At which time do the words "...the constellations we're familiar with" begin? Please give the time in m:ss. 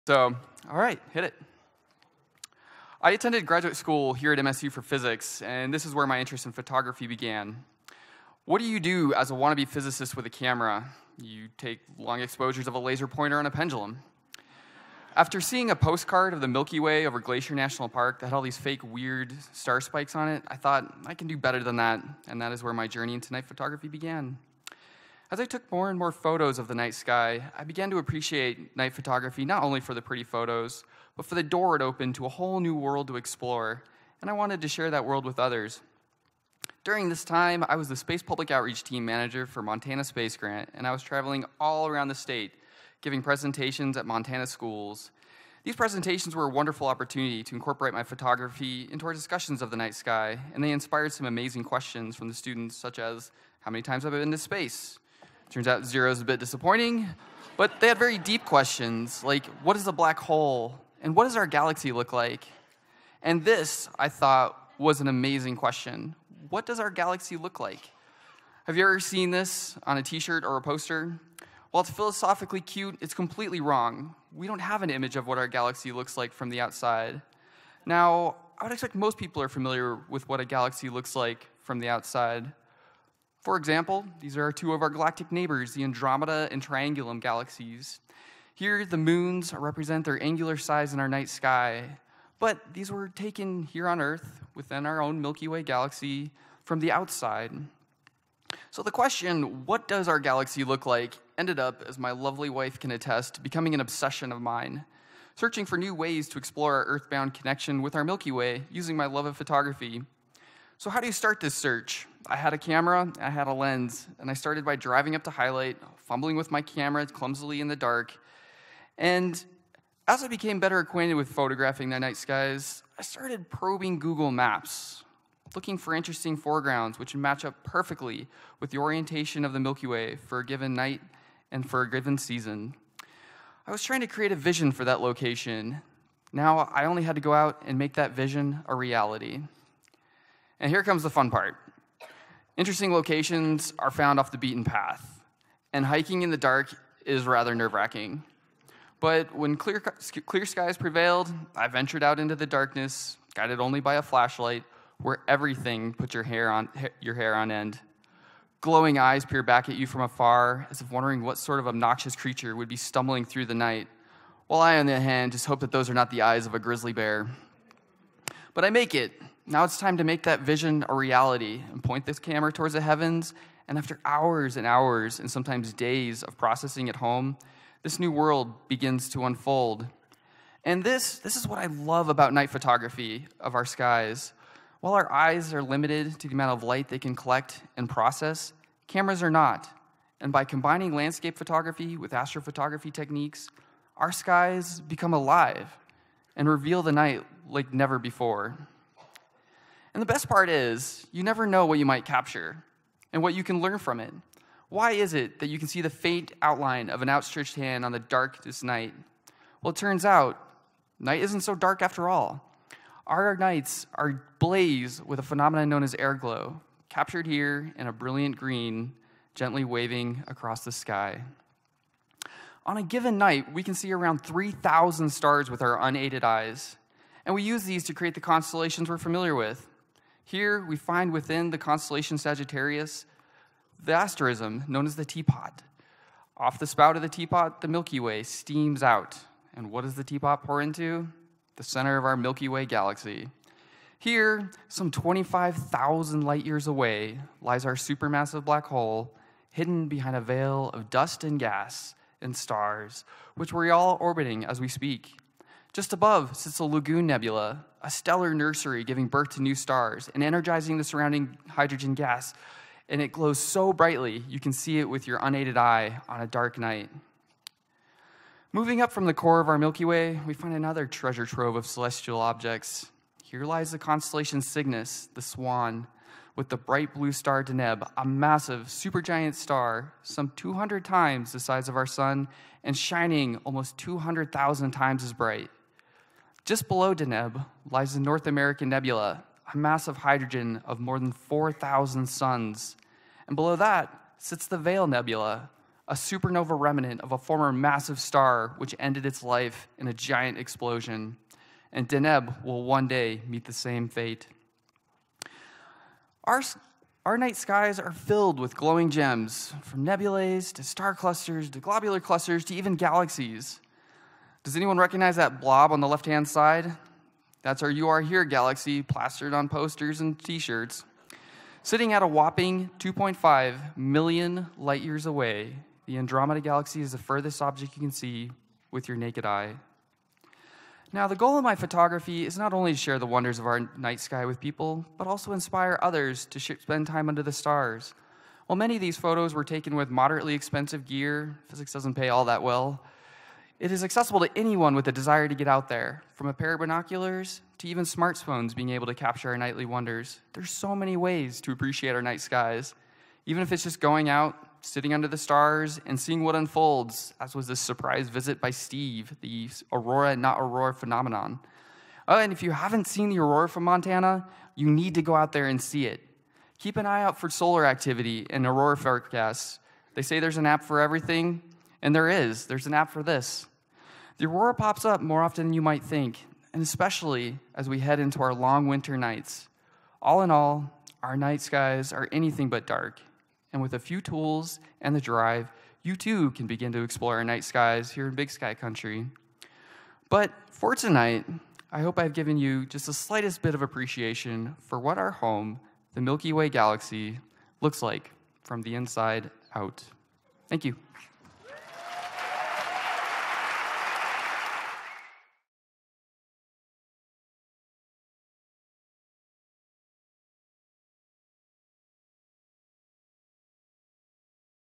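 3:48.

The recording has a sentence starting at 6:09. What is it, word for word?
They say there's an app for everything, and there is.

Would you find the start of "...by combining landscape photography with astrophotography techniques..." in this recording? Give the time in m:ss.
3:10.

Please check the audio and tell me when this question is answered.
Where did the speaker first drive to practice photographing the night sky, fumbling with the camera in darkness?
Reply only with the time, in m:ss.
1:55.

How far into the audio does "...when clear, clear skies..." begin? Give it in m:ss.
2:29.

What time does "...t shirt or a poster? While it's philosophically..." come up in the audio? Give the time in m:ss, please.
1:10.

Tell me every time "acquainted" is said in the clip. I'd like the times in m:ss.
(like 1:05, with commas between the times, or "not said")
2:00.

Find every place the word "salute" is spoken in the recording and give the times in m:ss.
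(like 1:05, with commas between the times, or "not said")
not said.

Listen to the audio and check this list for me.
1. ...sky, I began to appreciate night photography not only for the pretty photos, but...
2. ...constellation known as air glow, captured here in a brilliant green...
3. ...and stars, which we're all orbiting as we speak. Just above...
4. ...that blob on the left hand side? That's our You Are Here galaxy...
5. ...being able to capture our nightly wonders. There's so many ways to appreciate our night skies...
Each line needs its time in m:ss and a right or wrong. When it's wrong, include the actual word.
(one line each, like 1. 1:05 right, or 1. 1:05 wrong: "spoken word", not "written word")
1. 0:26 right
2. 3:35 wrong: "phenomenon", not "constellation"
3. 4:12 right
4. 5:15 right
5. 5:48 right.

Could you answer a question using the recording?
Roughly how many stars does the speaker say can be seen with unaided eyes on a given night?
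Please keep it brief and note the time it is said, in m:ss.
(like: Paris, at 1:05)
3,000, at 3:44.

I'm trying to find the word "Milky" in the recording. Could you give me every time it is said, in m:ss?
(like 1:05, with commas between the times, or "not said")
0:16, 1:35, 1:48, 2:09, 3:57, 4:02, 4:29, 6:36.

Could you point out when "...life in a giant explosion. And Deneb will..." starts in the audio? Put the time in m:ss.
4:59.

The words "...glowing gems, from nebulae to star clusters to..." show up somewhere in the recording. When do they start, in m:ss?
5:08.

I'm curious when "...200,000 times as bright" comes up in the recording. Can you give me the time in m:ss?
4:43.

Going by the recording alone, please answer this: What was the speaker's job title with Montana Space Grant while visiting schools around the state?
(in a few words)
Space Public Outreach Team Manager.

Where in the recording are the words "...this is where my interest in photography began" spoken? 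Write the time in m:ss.
0:05.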